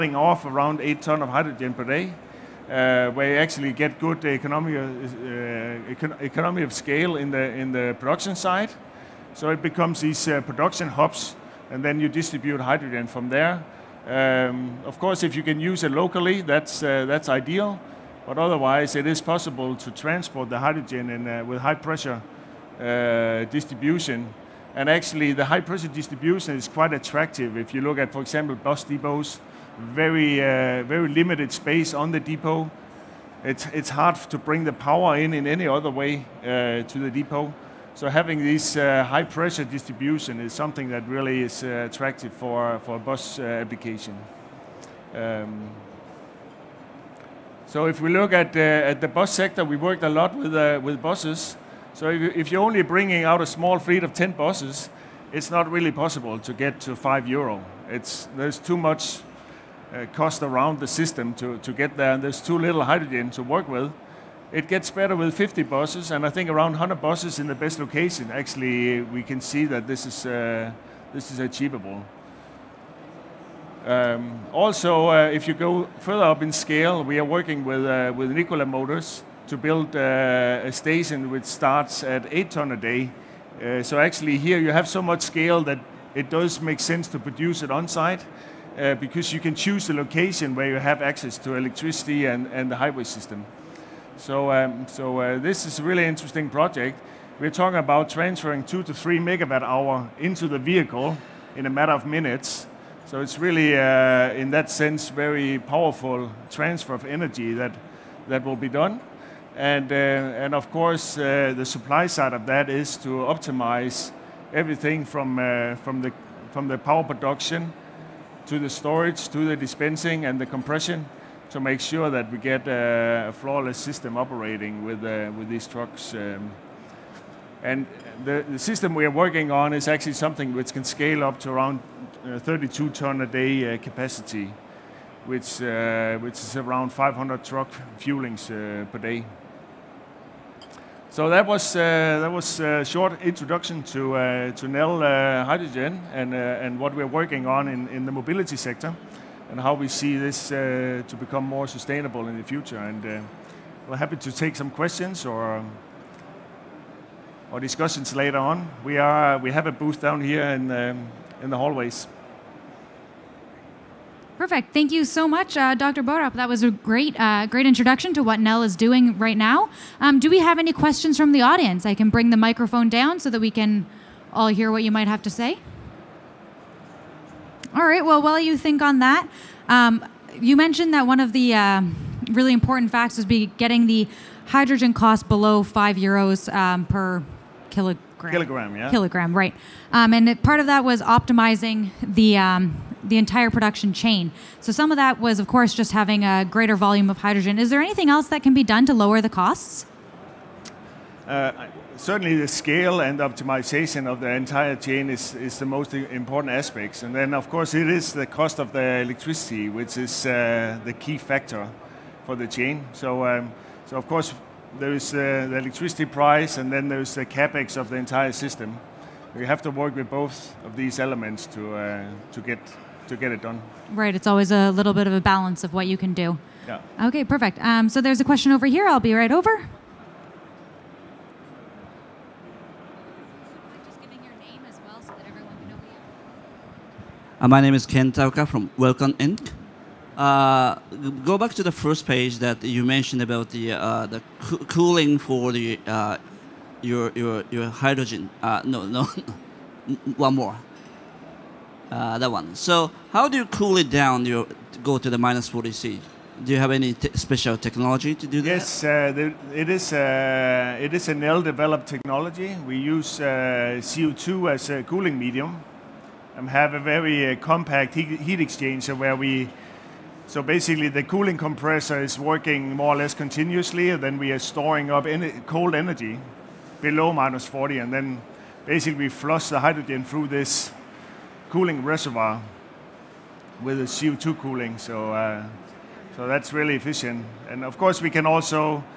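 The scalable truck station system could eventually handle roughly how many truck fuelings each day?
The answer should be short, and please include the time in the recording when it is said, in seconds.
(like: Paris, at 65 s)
500, at 136 s.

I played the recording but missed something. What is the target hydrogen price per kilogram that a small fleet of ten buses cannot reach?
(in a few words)
5 euros.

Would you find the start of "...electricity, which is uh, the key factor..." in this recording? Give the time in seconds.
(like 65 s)
209 s.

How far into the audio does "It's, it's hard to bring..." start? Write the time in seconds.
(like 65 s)
33 s.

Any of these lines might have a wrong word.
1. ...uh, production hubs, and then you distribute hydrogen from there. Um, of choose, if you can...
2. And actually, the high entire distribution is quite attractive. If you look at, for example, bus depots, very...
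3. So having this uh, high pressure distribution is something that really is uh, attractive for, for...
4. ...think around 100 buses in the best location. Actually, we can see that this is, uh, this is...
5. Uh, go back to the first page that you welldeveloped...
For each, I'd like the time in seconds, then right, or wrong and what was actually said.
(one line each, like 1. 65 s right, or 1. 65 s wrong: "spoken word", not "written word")
1. 10 s wrong: "course", not "choose"
2. 24 s wrong: "pressure", not "entire"
3. 37 s right
4. 66 s right
5. 240 s wrong: "mentioned", not "welldeveloped".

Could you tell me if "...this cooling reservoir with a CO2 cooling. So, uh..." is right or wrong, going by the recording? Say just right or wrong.
right.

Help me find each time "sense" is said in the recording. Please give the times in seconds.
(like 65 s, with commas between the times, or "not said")
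86 s, 104 s.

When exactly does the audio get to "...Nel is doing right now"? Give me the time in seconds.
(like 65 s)
168 s.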